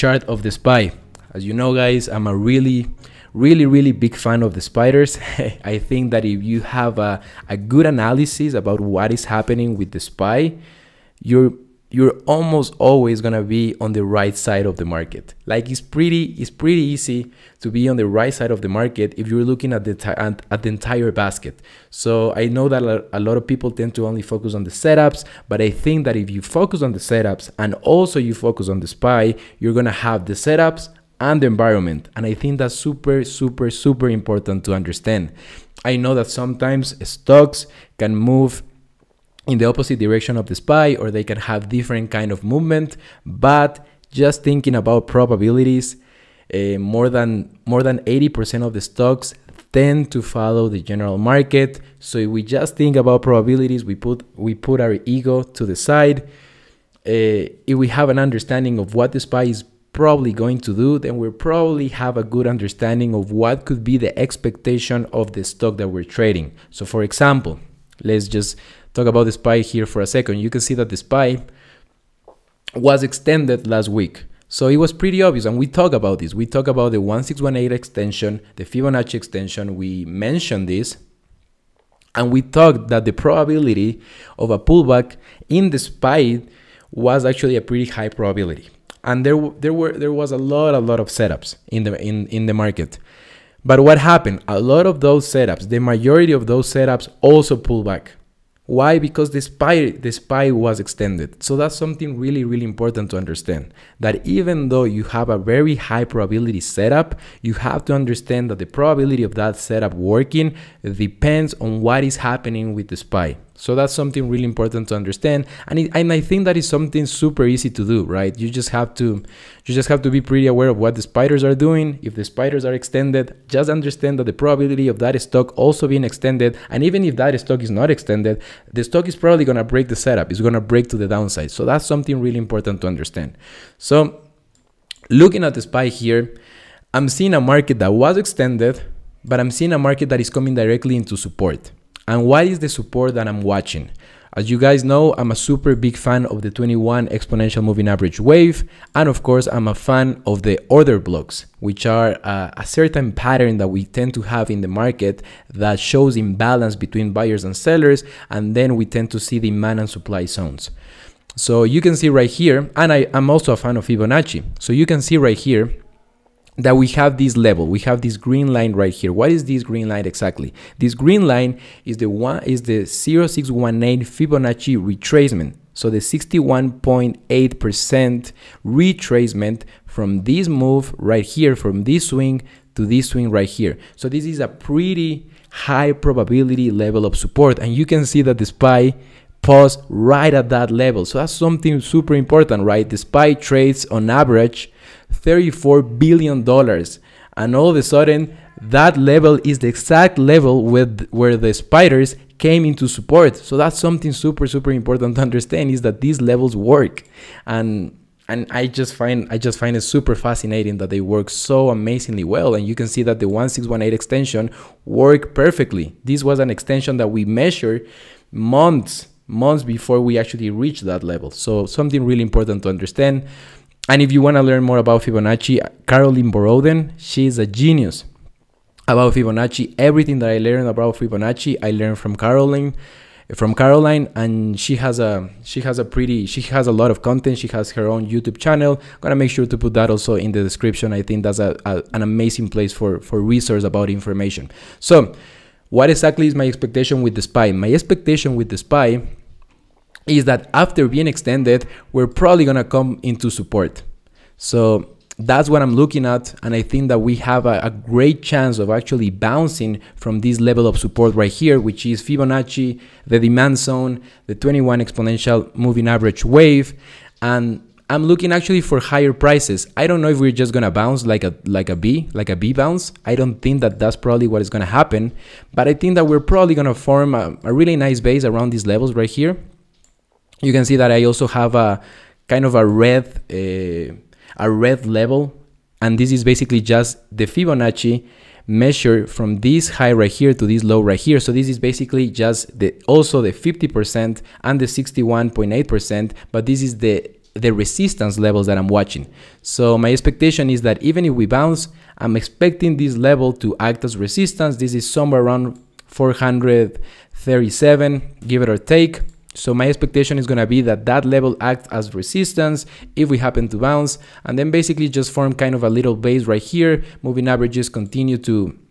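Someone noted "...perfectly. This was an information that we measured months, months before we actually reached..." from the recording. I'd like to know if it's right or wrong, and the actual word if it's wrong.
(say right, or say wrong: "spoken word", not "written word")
wrong: "extension", not "information".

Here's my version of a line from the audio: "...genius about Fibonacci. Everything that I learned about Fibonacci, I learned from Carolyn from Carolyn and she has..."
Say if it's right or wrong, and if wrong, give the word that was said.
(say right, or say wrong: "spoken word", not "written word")
right.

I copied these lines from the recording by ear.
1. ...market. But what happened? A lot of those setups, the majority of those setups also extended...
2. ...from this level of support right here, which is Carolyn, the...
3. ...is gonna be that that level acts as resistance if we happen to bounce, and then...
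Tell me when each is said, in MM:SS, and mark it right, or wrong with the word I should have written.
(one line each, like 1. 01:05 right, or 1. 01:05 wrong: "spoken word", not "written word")
1. 01:32 wrong: "pulled", not "extended"
2. 04:19 wrong: "Fibonacci", not "Carolyn"
3. 05:10 right.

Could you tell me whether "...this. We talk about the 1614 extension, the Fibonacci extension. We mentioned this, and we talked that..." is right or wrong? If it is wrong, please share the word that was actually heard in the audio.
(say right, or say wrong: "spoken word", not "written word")
wrong: "1618", not "1614".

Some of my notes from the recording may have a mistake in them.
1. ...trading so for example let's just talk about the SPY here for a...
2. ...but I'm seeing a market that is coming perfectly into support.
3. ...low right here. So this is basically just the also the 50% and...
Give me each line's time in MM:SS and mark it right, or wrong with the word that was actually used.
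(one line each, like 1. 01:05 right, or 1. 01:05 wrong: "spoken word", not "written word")
1. 01:06 right
2. 02:19 wrong: "directly", not "perfectly"
3. 04:50 right.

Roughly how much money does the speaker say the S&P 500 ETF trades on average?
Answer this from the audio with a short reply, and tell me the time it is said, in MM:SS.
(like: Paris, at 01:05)
$34 billion, at 03:15.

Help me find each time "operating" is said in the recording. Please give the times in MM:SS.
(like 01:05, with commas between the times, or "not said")
not said.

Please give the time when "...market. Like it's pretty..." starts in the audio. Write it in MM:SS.
00:14.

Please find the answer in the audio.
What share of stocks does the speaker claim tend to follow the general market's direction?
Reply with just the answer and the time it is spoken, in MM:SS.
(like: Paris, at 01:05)
more than 80%, at 00:47.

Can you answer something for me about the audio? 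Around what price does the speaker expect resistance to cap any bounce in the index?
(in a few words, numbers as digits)
437.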